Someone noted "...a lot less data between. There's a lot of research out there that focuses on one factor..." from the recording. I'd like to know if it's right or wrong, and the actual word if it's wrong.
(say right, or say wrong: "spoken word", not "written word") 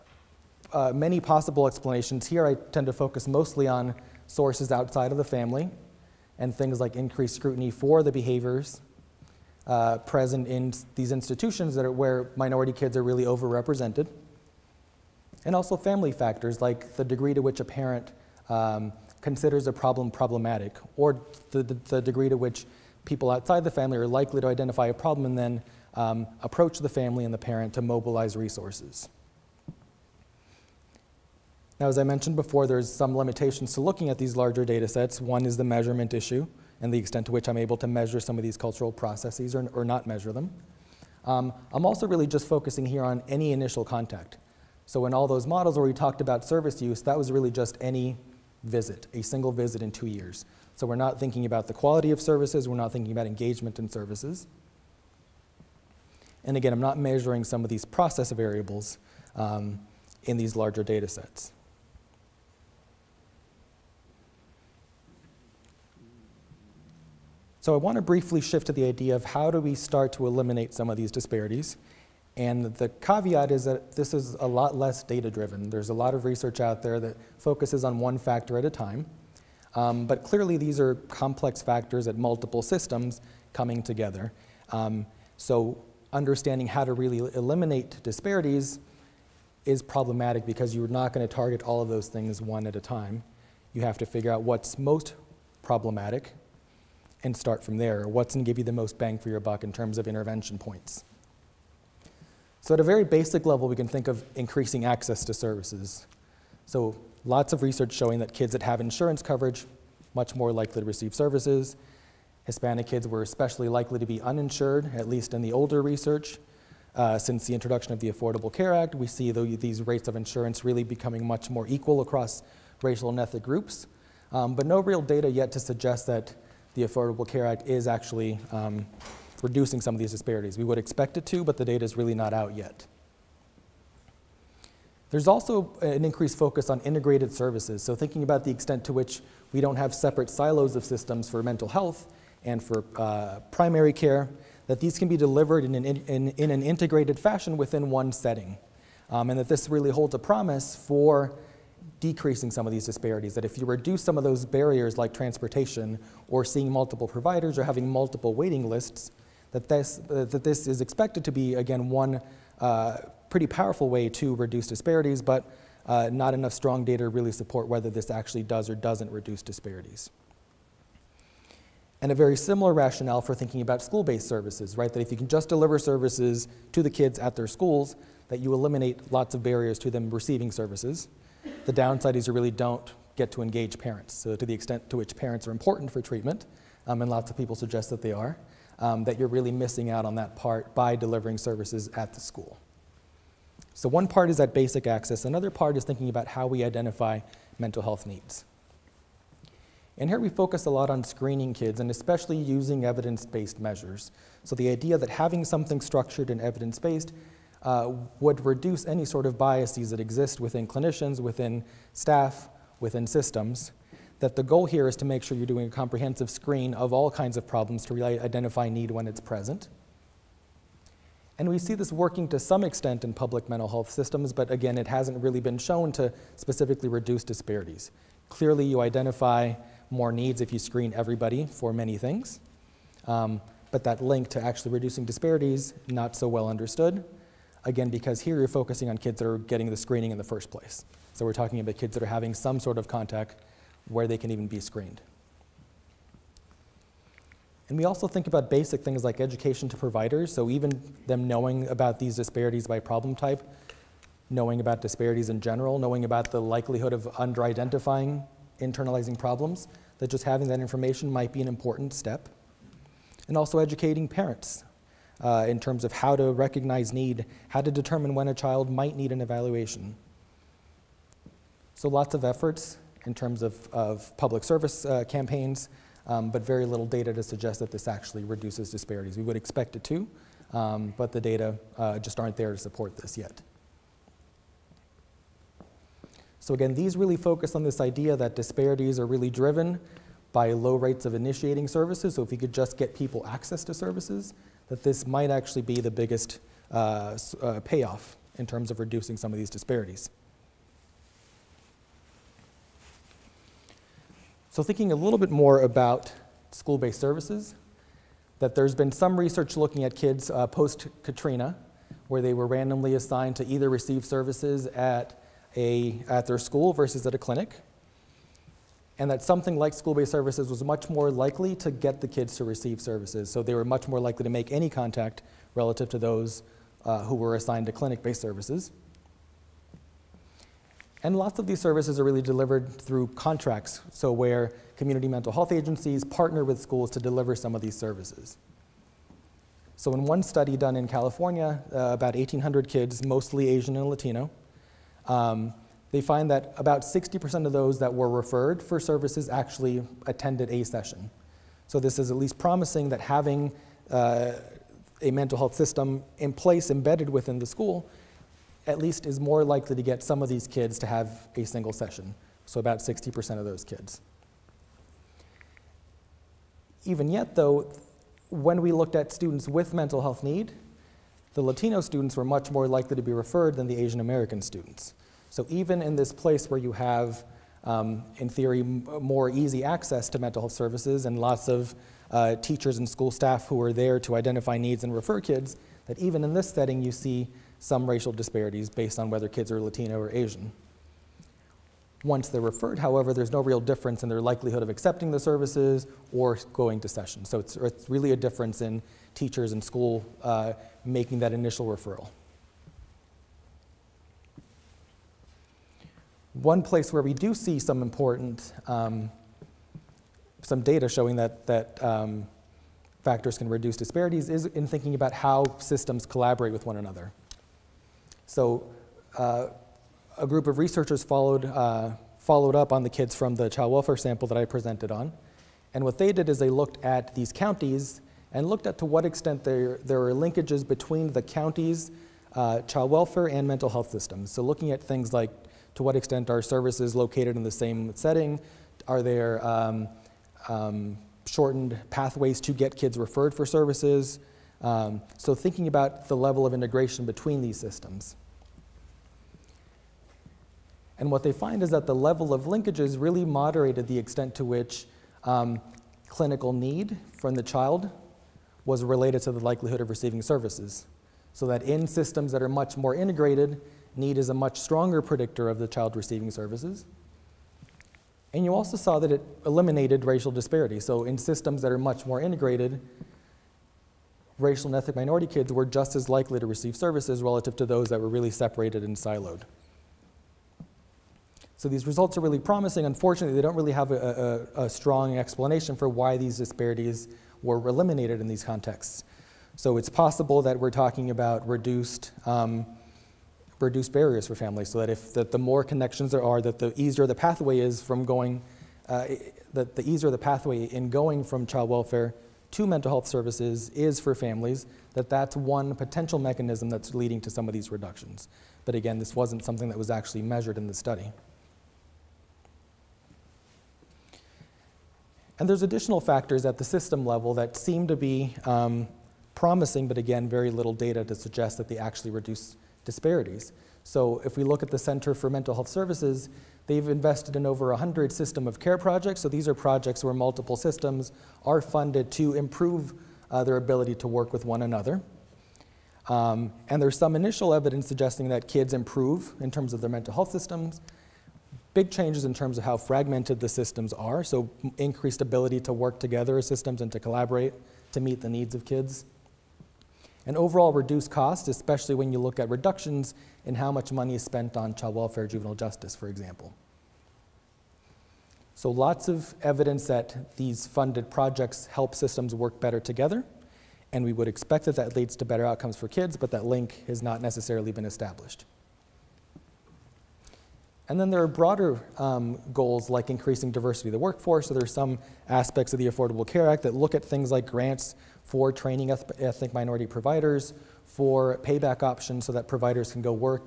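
wrong: "driven", not "between".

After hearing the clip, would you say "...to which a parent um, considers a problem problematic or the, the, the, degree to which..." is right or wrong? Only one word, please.
right.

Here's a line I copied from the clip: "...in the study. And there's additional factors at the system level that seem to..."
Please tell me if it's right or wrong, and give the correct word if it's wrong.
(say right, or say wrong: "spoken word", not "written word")
right.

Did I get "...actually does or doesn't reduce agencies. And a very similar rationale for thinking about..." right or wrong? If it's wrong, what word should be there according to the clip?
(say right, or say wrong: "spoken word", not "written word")
wrong: "disparities", not "agencies".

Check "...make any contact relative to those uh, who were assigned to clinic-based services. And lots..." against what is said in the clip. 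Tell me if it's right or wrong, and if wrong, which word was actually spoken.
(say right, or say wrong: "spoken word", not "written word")
right.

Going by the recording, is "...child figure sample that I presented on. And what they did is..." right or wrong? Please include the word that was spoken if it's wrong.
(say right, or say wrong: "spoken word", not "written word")
wrong: "welfare", not "figure".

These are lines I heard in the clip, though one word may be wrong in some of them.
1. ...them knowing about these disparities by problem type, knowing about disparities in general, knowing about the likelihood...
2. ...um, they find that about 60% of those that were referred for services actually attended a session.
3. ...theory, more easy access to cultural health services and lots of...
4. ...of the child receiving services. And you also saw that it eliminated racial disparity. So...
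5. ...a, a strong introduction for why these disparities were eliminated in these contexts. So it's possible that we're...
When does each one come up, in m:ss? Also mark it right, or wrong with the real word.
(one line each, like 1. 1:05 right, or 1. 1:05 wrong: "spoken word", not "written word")
1. 4:11 right
2. 5:45 right
3. 6:18 wrong: "mental", not "cultural"
4. 7:45 right
5. 8:04 wrong: "explanation", not "introduction".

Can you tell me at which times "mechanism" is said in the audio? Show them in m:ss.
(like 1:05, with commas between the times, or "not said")
8:26.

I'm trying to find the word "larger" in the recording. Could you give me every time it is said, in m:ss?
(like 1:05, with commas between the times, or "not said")
0:34, 1:00.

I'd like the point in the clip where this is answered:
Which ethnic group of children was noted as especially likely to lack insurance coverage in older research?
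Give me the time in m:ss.
1:52.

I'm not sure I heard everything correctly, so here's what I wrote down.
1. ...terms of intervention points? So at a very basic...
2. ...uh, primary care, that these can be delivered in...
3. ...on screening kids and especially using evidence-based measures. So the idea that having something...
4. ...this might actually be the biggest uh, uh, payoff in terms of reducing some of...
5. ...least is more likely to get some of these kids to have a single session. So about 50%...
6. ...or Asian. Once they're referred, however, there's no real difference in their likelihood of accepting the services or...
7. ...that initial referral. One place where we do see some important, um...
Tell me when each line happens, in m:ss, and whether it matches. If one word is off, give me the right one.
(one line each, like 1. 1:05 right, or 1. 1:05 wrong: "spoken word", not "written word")
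1. 1:39 right
2. 2:22 right
3. 3:20 right
4. 4:54 right
5. 5:58 wrong: "60", not "50"
6. 6:29 right
7. 6:41 right.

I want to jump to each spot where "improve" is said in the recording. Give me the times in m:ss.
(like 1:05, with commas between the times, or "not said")
8:52, 8:58.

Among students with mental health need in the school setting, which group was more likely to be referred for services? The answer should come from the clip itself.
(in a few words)
Latino students.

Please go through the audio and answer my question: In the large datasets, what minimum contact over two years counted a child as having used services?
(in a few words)
a single visit.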